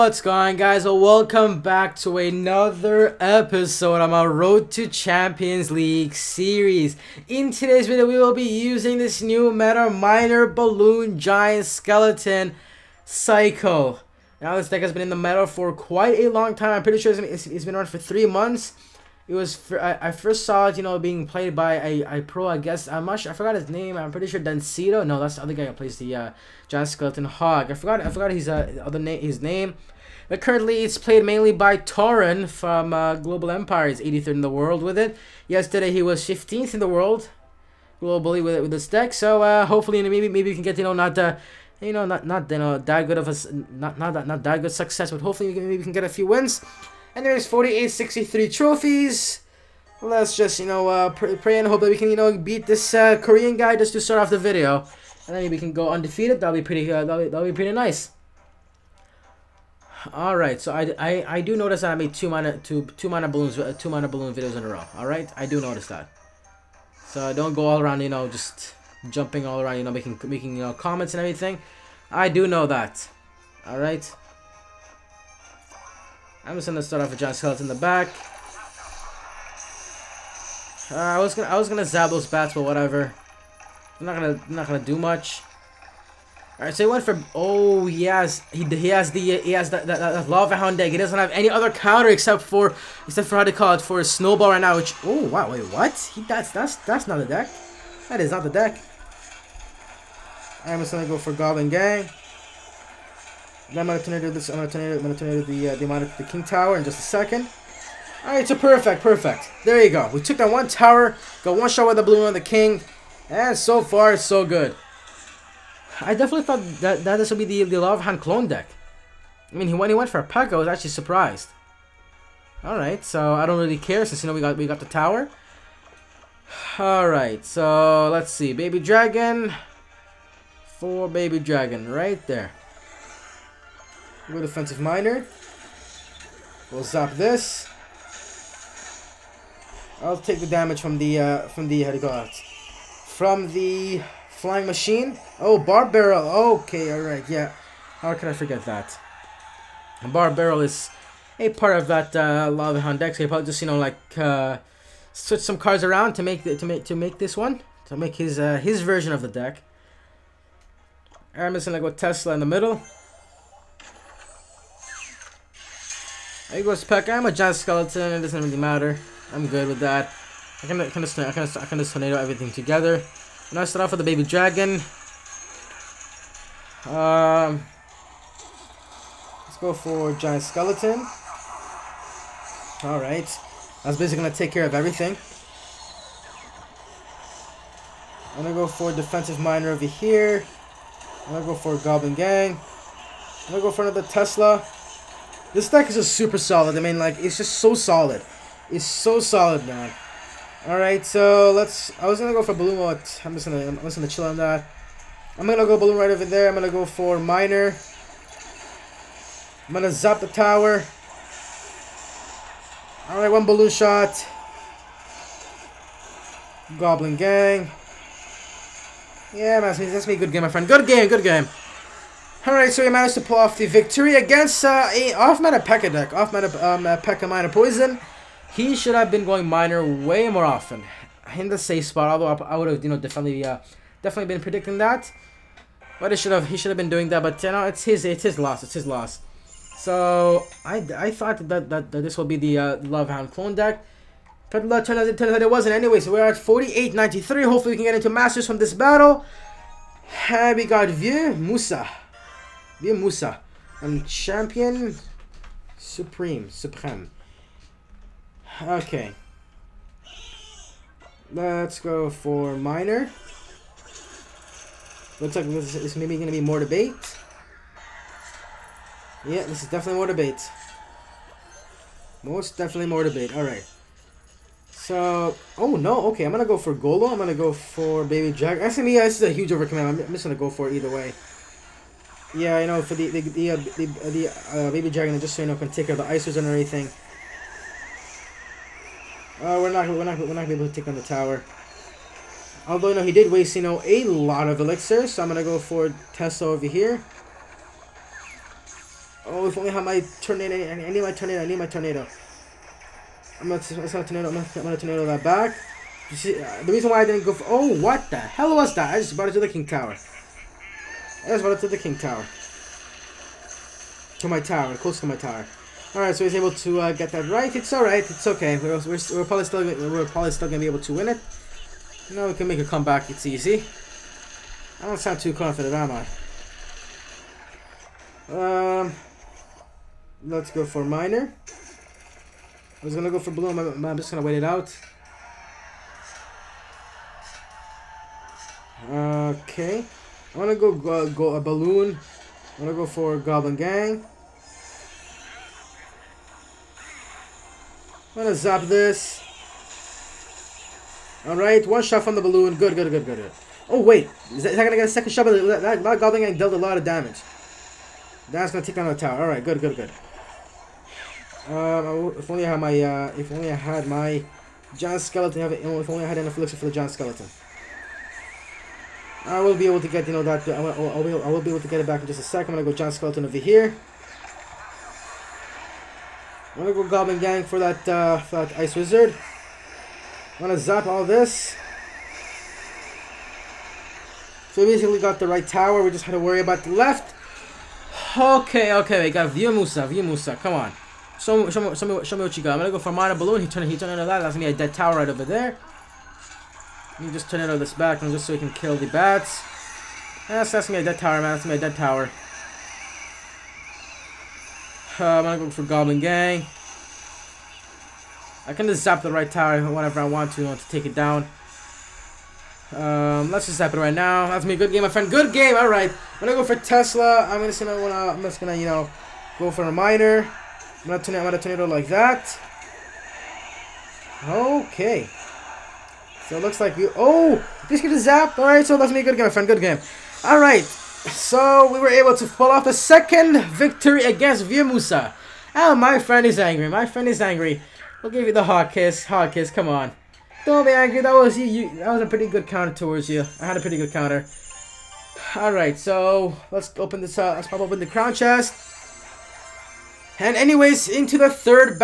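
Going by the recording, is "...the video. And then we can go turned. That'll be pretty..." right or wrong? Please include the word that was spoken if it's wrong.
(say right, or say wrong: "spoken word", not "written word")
wrong: "undefeated", not "turned".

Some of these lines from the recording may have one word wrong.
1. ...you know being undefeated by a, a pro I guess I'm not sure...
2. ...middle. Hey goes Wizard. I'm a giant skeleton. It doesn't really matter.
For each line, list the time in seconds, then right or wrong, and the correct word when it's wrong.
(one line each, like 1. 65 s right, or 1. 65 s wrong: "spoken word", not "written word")
1. 20 s wrong: "played", not "undefeated"
2. 162 s wrong: "Peck", not "Wizard".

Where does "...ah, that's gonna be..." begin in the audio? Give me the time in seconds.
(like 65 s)
400 s.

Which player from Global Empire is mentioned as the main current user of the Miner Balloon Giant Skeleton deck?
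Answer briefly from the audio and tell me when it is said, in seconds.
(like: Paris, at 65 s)
Torin, at 31 s.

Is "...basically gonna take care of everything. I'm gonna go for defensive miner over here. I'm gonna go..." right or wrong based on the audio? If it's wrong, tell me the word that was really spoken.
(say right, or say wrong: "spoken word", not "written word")
right.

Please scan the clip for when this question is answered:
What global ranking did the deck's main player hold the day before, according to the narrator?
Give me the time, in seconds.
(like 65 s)
36 s.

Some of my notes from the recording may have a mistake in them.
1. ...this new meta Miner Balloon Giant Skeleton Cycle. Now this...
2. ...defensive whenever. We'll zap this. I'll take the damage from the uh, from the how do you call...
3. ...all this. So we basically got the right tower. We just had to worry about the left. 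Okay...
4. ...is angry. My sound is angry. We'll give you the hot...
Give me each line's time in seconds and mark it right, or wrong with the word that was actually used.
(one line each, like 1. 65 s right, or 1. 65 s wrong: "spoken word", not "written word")
1. 8 s right
2. 134 s wrong: "miner", not "whenever"
3. 380 s right
4. 436 s wrong: "friend", not "sound".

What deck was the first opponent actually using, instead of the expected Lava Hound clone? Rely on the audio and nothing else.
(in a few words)
P.E.K.K.A Miner Poison.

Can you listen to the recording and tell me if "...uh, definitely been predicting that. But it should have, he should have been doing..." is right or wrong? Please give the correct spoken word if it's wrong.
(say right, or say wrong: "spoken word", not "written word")
right.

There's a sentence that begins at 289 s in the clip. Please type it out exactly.
Uh, we're not we're not we're not able to take on the tower.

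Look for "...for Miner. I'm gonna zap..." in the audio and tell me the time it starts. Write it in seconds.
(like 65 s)
206 s.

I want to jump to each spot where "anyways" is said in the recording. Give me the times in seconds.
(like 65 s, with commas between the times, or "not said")
245 s, 450 s.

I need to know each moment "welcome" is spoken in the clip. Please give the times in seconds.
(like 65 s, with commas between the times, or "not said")
0 s.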